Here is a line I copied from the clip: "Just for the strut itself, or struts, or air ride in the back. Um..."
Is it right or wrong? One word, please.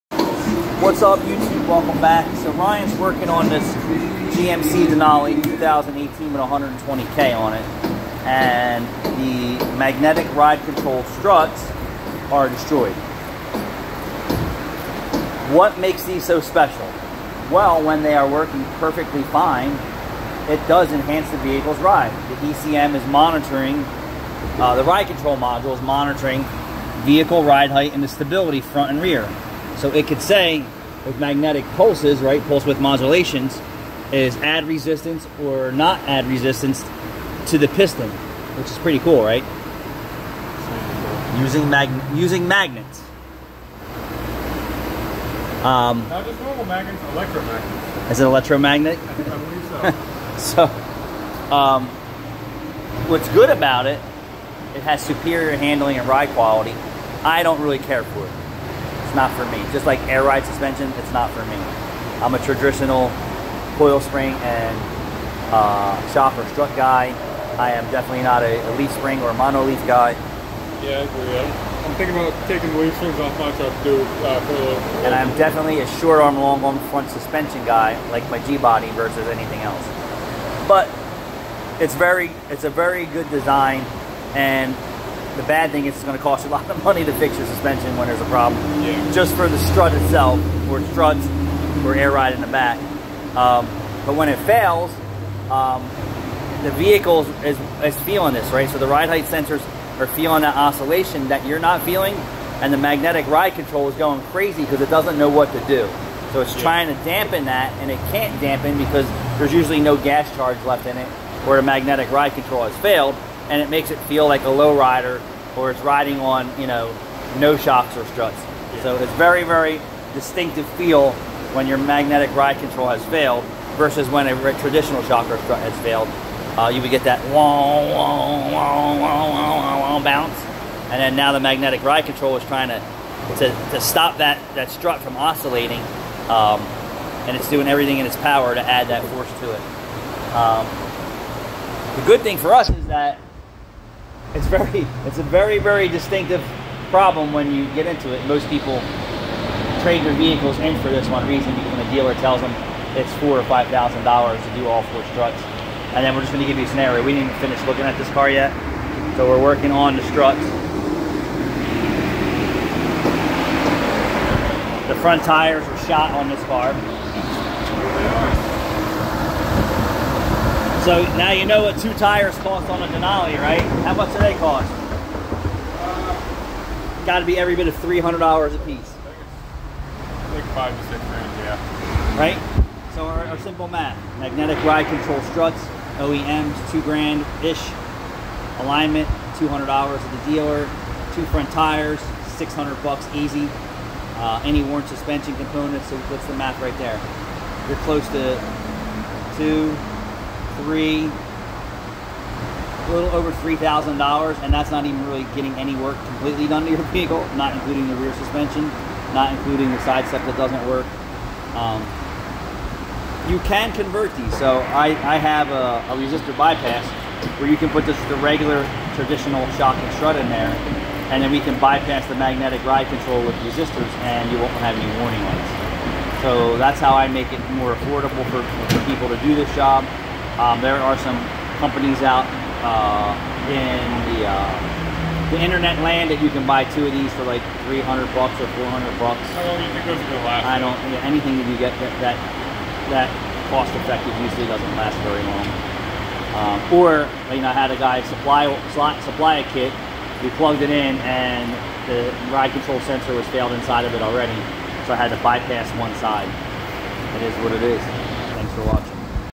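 right.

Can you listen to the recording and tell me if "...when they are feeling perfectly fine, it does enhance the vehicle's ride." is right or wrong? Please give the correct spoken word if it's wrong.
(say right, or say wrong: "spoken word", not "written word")
wrong: "working", not "feeling".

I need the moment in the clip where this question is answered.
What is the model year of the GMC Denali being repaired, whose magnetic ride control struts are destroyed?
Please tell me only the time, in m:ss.
0:05.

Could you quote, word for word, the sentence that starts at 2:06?
Uh, you would get that whoa, whoa, whoa, wah, bounce.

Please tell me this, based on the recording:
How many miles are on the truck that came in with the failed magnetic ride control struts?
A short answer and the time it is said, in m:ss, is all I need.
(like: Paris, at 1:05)
120K, at 0:06.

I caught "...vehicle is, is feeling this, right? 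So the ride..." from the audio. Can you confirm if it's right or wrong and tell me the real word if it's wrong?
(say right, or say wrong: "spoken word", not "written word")
right.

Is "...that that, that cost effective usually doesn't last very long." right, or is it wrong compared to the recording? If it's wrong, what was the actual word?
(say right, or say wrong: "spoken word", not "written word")
right.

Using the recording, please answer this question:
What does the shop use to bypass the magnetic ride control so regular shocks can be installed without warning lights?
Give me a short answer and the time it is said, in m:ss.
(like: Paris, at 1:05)
Resistors, at 3:43.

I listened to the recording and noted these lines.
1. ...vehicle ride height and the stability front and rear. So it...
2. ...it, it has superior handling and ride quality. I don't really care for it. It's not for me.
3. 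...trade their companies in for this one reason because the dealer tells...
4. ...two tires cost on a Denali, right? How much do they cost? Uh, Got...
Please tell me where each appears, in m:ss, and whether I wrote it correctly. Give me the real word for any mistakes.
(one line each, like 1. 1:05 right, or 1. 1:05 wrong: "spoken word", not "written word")
1. 0:27 right
2. 0:53 right
3. 2:29 wrong: "vehicles", not "companies"
4. 2:51 right.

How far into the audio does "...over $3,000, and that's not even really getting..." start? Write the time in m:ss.
3:23.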